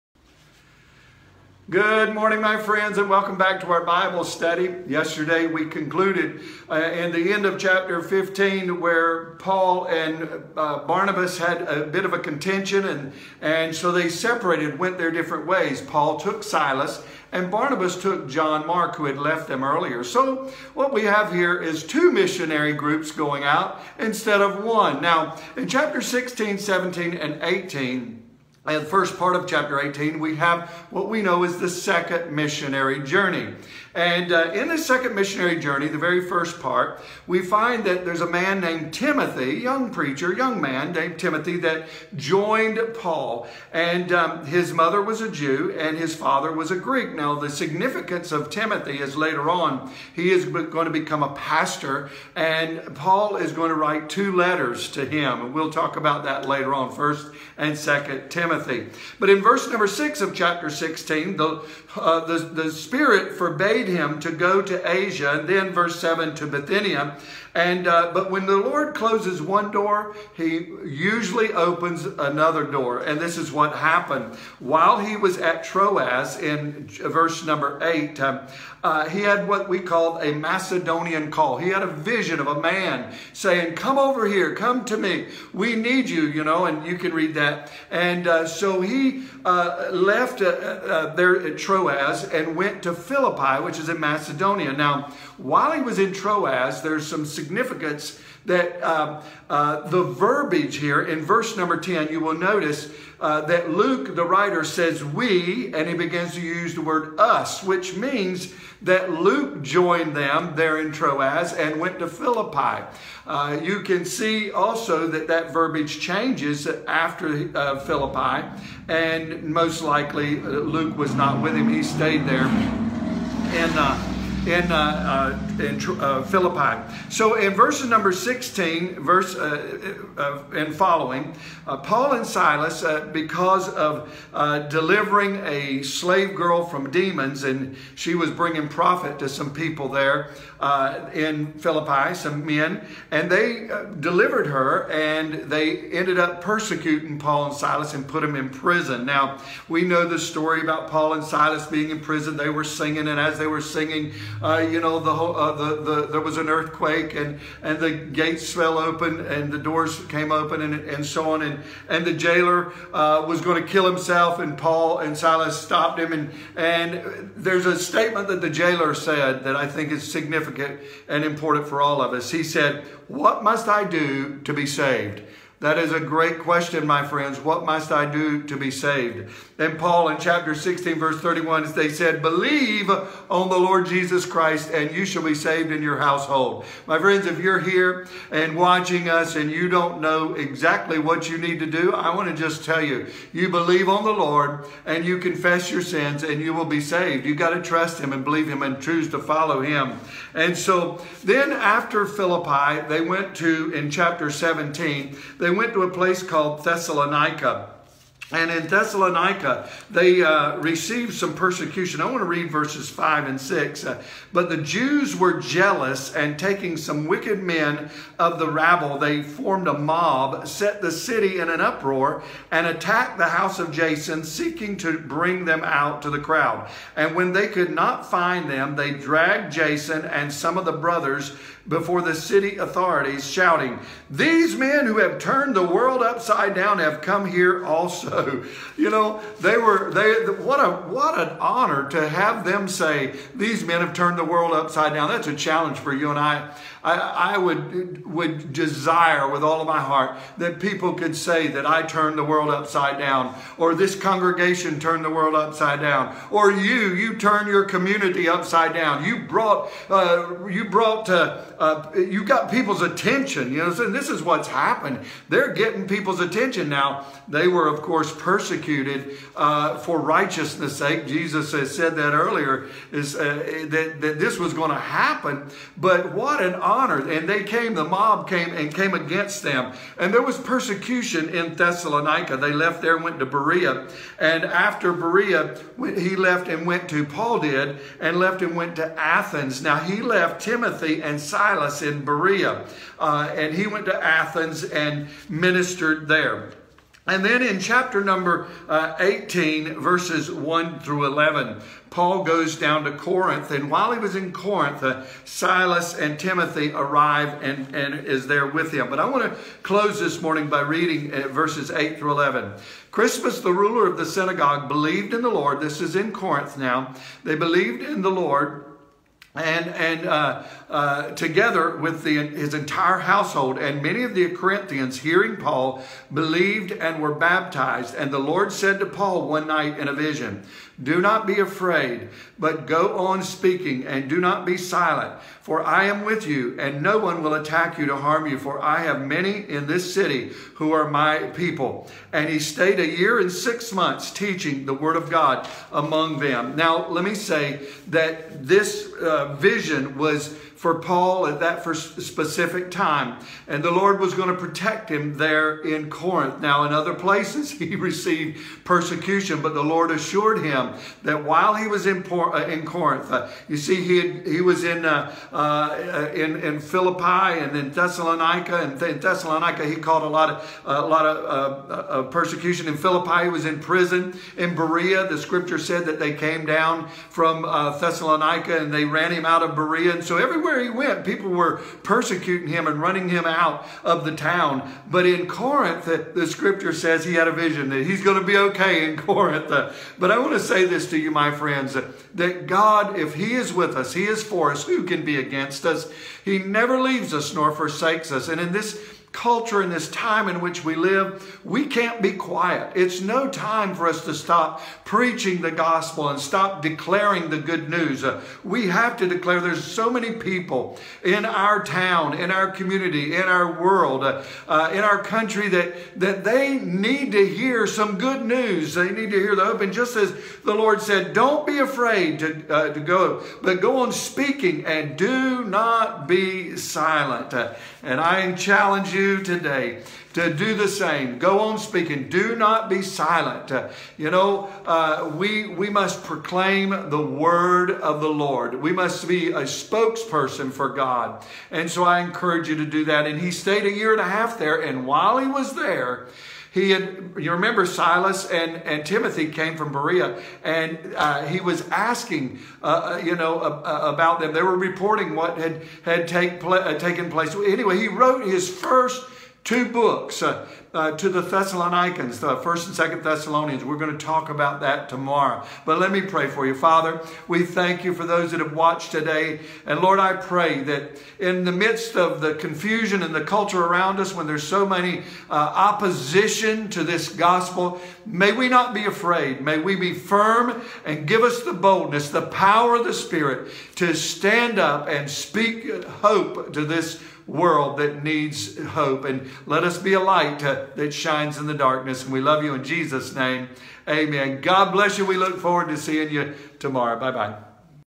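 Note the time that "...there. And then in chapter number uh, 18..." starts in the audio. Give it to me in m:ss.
4:56.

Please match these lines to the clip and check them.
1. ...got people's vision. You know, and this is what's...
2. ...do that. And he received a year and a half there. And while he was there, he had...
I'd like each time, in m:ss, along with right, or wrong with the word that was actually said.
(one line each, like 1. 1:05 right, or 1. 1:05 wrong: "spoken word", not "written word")
1. 4:22 wrong: "attention", not "vision"
2. 7:22 wrong: "stayed", not "received".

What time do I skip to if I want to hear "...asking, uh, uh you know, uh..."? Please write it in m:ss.
7:31.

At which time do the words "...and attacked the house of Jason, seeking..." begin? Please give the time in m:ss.
3:42.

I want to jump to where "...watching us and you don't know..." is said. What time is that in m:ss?
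3:08.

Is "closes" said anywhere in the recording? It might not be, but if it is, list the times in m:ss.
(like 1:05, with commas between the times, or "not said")
1:08, 5:09.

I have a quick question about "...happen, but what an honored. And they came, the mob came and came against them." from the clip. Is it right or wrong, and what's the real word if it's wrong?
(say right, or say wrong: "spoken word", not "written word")
right.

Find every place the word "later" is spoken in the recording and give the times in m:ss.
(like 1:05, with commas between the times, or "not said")
0:49, 0:56.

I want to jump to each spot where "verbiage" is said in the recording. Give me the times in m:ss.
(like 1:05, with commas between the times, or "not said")
1:40, 1:55.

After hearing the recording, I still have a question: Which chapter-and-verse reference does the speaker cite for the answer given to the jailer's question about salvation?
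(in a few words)
Chapter 16, verse 31.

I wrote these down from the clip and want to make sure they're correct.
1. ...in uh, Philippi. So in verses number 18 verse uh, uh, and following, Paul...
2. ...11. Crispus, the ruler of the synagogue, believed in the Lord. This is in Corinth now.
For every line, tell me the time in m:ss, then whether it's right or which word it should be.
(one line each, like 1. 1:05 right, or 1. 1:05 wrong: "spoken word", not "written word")
1. 2:05 wrong: "16", not "18"
2. 5:12 right.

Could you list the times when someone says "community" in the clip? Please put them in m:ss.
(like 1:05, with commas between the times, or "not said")
4:17, 6:52.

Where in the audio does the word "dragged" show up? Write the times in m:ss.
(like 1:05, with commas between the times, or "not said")
3:48.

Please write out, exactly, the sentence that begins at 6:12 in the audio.
In Philippi, he was in prison.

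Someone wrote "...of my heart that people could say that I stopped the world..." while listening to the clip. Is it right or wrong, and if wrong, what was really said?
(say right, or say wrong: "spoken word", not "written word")
wrong: "turned", not "stopped".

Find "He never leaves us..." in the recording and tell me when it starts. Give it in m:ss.
6:36.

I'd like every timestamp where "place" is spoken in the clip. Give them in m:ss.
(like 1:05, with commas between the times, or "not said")
3:25, 5:56, 7:37.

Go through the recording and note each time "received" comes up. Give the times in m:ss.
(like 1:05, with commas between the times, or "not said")
3:30, 5:57.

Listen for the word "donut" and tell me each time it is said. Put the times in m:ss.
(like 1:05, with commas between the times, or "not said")
not said.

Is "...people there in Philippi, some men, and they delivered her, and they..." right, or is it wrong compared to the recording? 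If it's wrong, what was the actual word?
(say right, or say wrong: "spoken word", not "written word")
right.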